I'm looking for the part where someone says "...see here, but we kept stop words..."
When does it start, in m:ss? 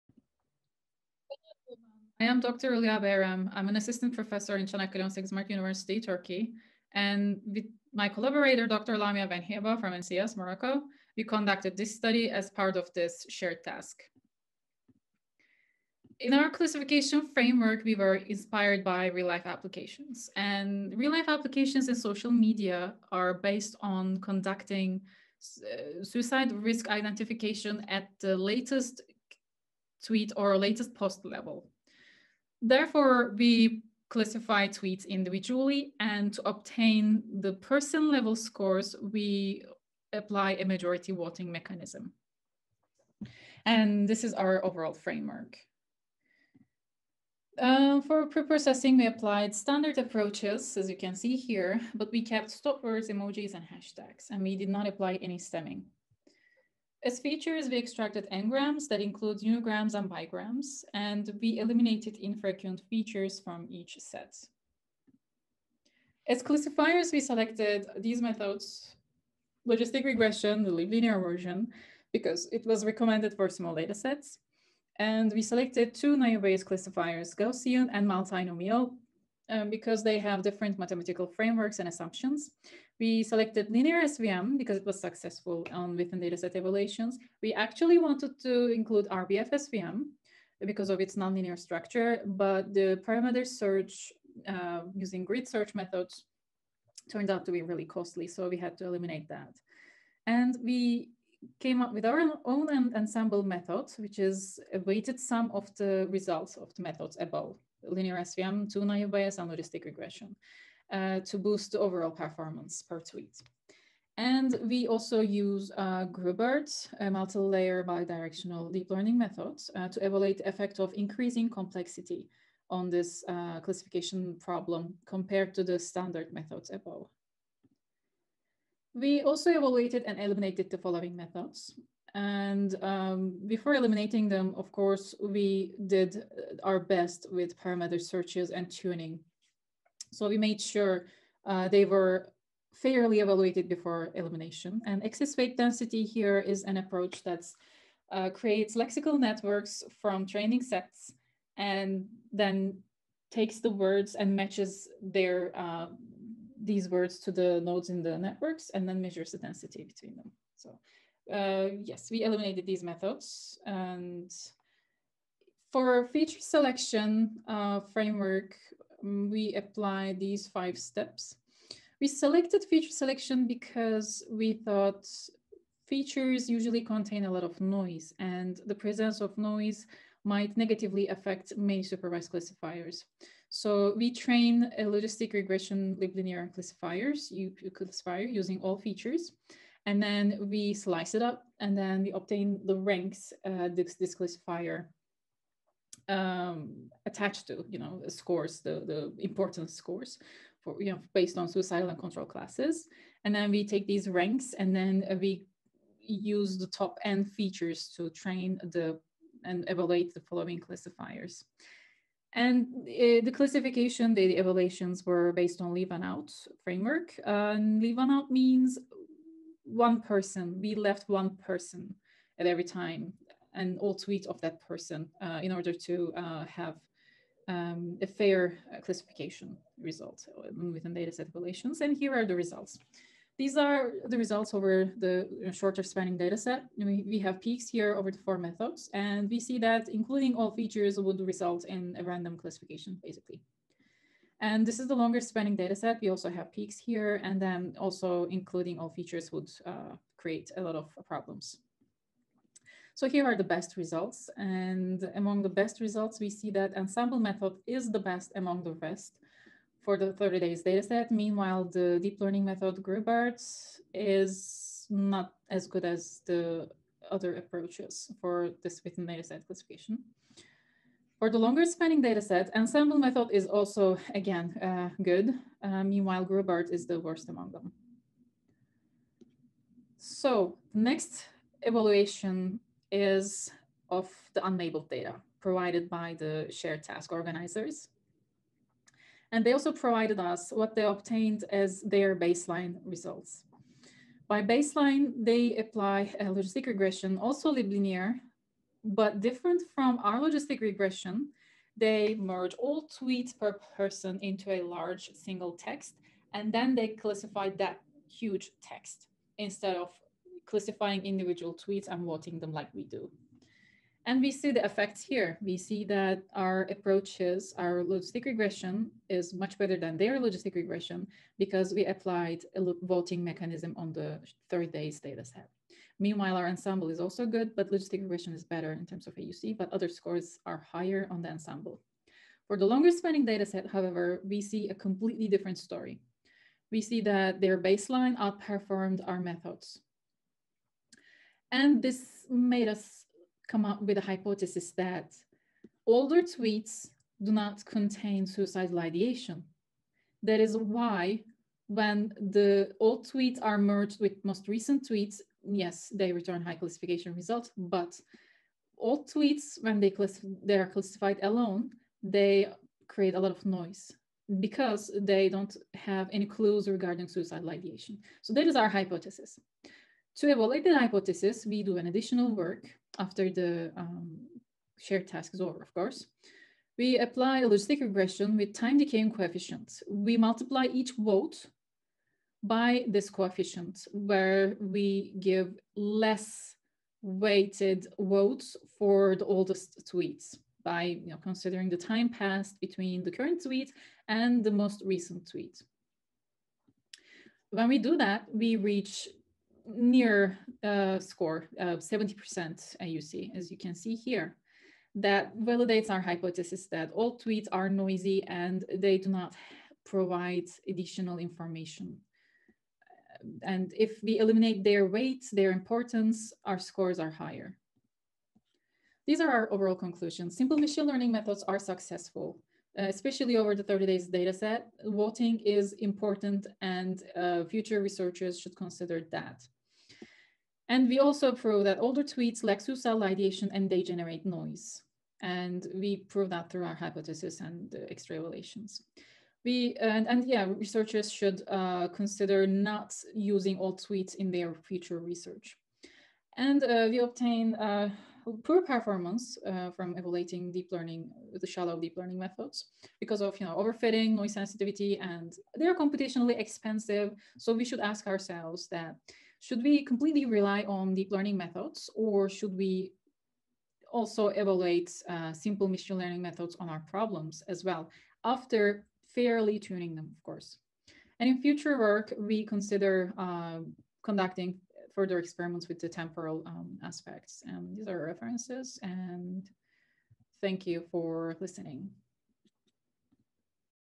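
0:51.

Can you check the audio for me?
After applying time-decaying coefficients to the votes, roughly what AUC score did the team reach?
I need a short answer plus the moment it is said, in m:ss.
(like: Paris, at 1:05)
70%, at 6:41.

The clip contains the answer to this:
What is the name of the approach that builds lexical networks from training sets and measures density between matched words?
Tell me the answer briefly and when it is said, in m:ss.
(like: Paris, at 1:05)
excess weight density, at 2:25.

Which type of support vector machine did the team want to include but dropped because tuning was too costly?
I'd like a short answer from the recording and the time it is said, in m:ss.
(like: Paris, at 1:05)
RBF SVM, at 1:29.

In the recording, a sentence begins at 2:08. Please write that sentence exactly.
We also evaluated and eliminated the following methods.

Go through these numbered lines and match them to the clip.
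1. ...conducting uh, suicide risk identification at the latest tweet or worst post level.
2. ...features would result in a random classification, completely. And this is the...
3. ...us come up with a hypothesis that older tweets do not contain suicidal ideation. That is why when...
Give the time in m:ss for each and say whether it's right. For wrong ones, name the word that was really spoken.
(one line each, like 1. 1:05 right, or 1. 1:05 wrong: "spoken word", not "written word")
1. 0:24 wrong: "latest", not "worst"
2. 4:00 wrong: "basically", not "completely"
3. 5:42 right.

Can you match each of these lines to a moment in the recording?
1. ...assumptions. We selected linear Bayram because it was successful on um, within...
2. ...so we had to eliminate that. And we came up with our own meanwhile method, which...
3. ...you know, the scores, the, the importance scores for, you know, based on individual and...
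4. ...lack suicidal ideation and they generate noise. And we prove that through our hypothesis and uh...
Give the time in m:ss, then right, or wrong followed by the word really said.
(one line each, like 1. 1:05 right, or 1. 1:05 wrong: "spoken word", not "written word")
1. 1:21 wrong: "SVM", not "Bayram"
2. 1:38 wrong: "ensemble", not "meanwhile"
3. 3:17 wrong: "suicidal", not "individual"
4. 7:12 right.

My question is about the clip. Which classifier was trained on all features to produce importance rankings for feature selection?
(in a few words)
logistic regression liblinear.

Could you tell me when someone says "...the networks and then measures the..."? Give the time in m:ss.
2:38.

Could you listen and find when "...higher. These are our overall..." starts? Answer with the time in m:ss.
6:57.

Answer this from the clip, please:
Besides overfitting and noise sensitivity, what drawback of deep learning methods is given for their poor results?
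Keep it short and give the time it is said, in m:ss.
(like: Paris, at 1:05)
computationally expensive, at 7:35.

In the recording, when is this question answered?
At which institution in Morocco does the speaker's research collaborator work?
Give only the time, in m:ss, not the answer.
0:09.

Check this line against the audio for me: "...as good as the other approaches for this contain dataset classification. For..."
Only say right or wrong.
wrong.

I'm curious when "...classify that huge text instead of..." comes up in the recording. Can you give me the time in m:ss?
5:06.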